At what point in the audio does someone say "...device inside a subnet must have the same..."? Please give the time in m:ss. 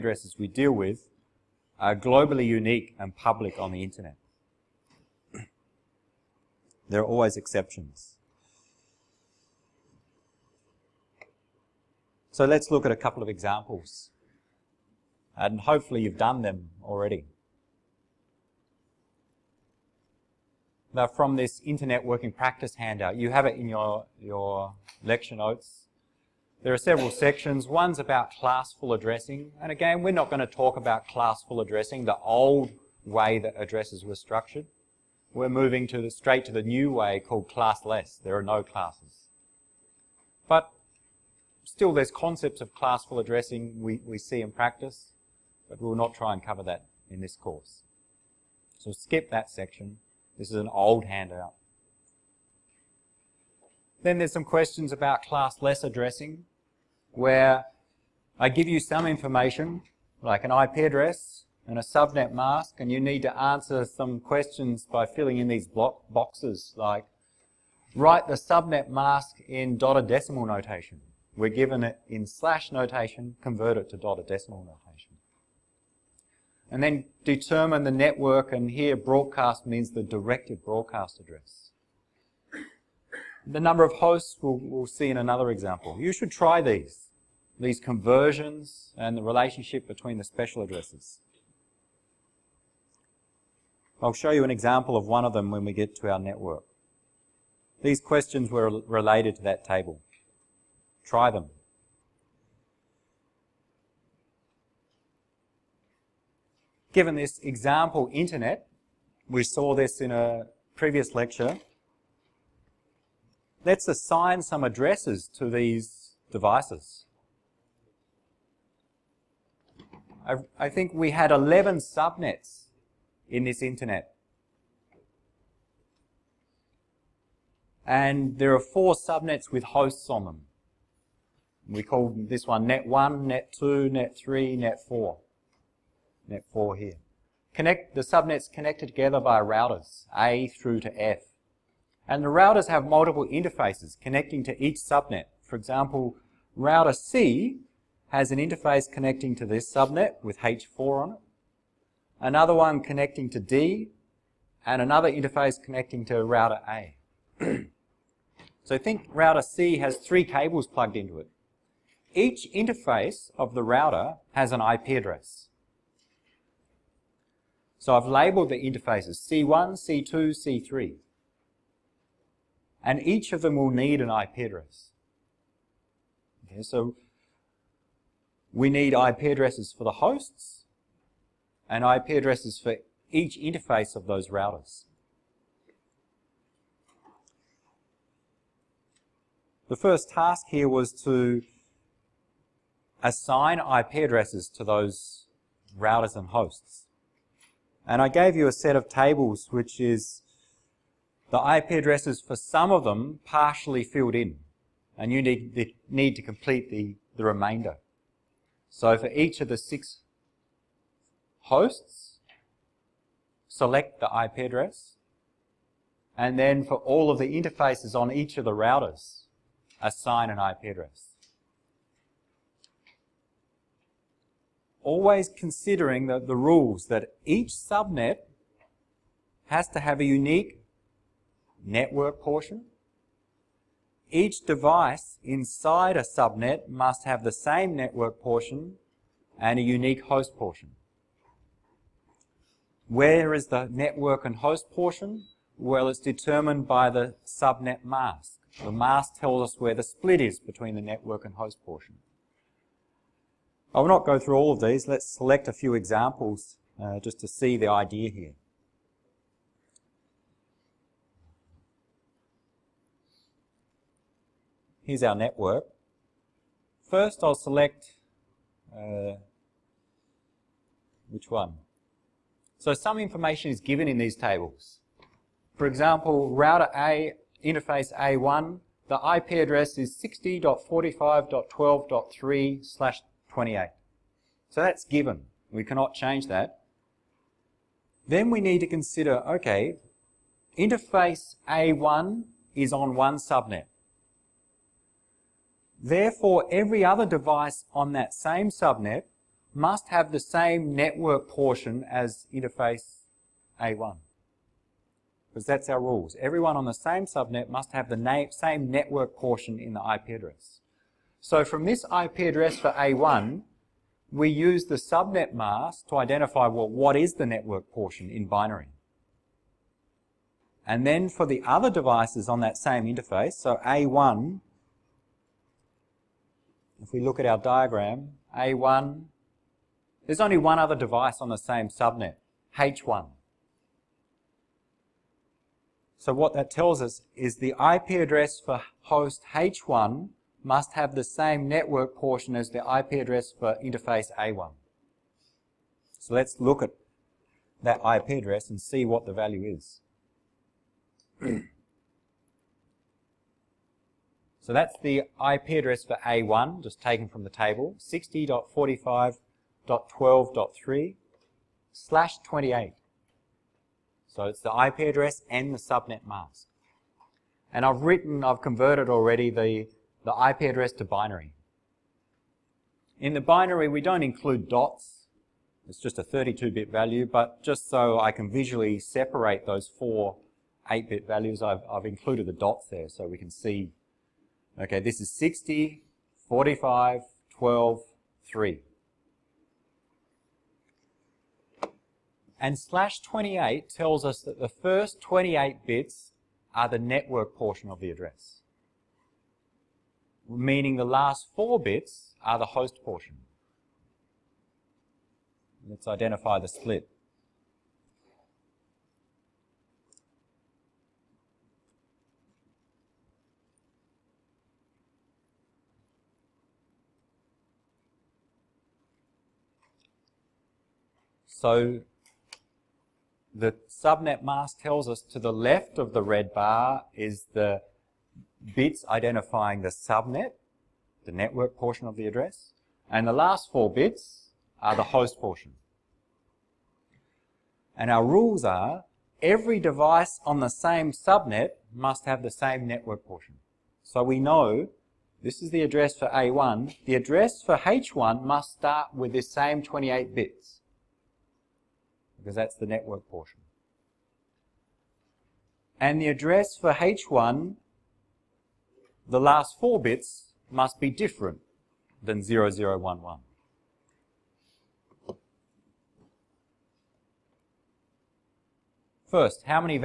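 3:54.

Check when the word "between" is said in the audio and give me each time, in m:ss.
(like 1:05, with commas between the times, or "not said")
1:29, 4:10.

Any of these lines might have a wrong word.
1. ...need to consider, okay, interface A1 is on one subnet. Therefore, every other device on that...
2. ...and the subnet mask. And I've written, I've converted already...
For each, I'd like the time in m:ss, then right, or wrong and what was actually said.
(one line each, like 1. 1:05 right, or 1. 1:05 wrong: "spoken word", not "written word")
1. 4:48 right
2. 6:05 right.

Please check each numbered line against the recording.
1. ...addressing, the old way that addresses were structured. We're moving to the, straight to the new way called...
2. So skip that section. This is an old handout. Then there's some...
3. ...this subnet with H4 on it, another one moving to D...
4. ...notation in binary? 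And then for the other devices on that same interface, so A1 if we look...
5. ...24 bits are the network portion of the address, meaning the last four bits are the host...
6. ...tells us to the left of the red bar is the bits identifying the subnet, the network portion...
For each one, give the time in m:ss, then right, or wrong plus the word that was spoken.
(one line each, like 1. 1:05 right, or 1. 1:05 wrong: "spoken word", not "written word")
1. 0:31 right
2. 0:48 right
3. 2:29 wrong: "connecting", not "moving"
4. 5:17 wrong: "portion", not "notation"
5. 6:35 wrong: "28", not "24"
6. 7:04 right.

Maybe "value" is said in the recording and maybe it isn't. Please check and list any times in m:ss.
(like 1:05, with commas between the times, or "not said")
5:49, 6:16, 6:21.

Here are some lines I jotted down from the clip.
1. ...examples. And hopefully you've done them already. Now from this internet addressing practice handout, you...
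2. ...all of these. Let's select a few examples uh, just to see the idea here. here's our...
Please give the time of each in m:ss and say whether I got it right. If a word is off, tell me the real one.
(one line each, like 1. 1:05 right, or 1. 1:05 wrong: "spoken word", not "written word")
1. 0:13 wrong: "working", not "addressing"
2. 4:14 right.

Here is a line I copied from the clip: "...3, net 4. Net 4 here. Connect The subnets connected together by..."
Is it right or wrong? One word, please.
right.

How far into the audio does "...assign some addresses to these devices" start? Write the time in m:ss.
1:53.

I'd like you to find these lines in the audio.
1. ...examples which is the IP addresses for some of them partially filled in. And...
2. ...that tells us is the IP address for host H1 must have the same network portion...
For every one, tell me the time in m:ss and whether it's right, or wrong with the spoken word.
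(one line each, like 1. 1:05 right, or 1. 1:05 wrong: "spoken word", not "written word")
1. 3:18 wrong: "tables", not "examples"
2. 5:36 right.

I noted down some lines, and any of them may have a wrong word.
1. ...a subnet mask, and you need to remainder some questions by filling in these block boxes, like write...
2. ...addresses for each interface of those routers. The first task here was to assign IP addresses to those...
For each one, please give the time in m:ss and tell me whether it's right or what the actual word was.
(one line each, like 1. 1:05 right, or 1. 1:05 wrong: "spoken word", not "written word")
1. 1:01 wrong: "answer", not "remainder"
2. 3:02 right.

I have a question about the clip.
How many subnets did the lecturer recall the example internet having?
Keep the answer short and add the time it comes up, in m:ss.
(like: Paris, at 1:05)
11, at 2:01.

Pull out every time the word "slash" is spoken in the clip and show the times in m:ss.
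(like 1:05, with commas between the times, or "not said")
1:12, 4:42, 6:01, 6:32.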